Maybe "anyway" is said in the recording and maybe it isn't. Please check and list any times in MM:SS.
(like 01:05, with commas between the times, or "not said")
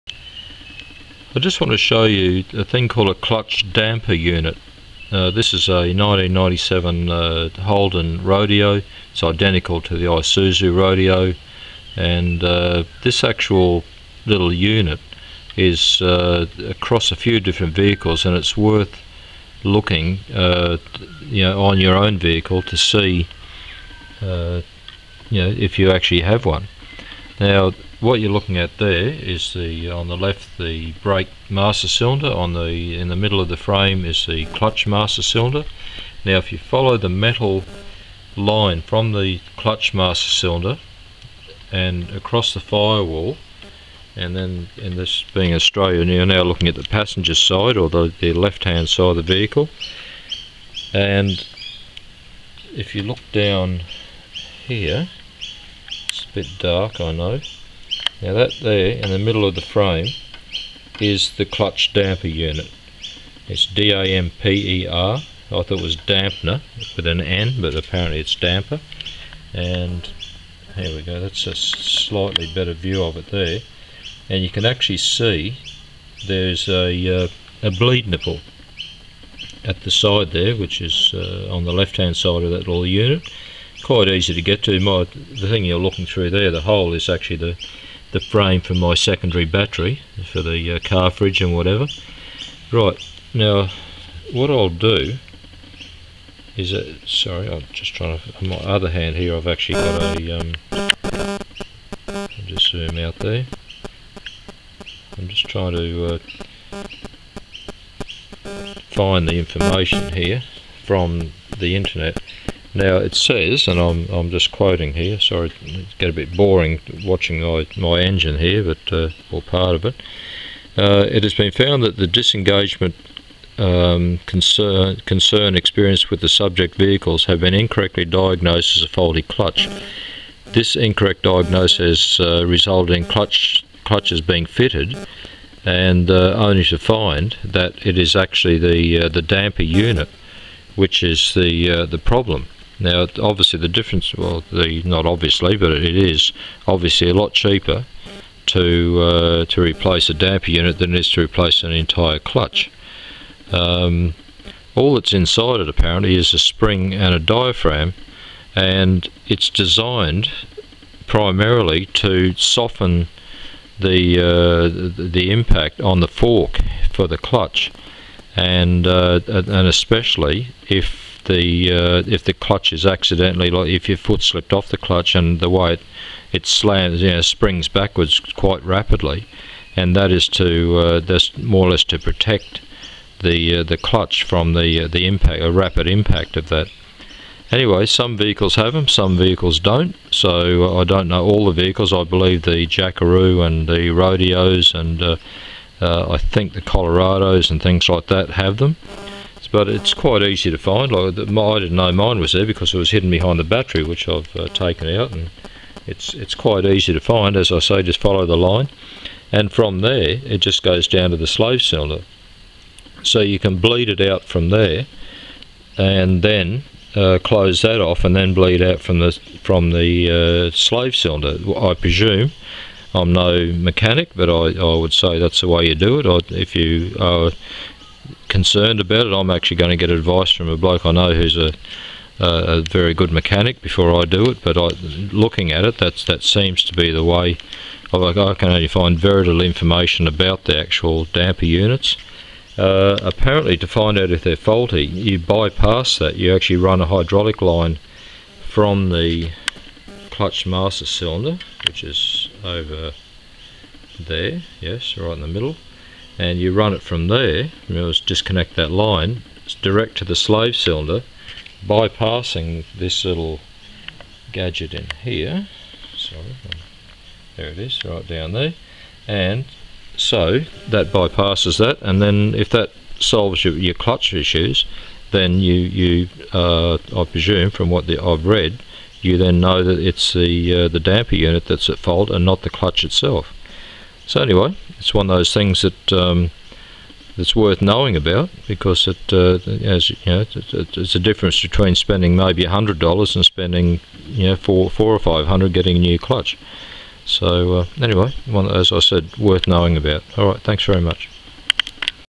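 03:07, 04:44, 04:57.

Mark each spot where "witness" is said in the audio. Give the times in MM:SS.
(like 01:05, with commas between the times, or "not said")
not said.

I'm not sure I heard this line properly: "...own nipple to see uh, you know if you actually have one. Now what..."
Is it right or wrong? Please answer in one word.
wrong.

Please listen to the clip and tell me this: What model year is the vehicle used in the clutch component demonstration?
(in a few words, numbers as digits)
1997.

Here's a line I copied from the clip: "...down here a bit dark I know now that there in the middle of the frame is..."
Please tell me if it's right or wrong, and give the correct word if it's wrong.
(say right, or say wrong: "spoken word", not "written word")
right.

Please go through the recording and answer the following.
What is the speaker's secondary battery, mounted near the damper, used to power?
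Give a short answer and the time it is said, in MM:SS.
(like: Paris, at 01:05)
Car fridge, at 01:30.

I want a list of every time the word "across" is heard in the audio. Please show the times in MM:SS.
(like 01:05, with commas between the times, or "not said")
00:16, 00:42.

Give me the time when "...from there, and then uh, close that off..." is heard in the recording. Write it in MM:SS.
03:34.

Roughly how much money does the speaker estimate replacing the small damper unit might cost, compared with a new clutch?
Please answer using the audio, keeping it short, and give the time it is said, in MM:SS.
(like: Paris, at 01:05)
$100, at 04:52.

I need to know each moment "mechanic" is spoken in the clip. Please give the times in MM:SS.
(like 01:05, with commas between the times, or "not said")
03:43, 03:53.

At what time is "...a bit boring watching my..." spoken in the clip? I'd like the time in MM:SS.
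01:56.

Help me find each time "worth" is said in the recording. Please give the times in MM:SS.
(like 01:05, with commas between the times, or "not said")
00:18, 04:47, 04:59.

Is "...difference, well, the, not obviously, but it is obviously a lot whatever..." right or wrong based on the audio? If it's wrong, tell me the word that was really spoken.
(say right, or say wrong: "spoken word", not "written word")
wrong: "cheaper", not "whatever".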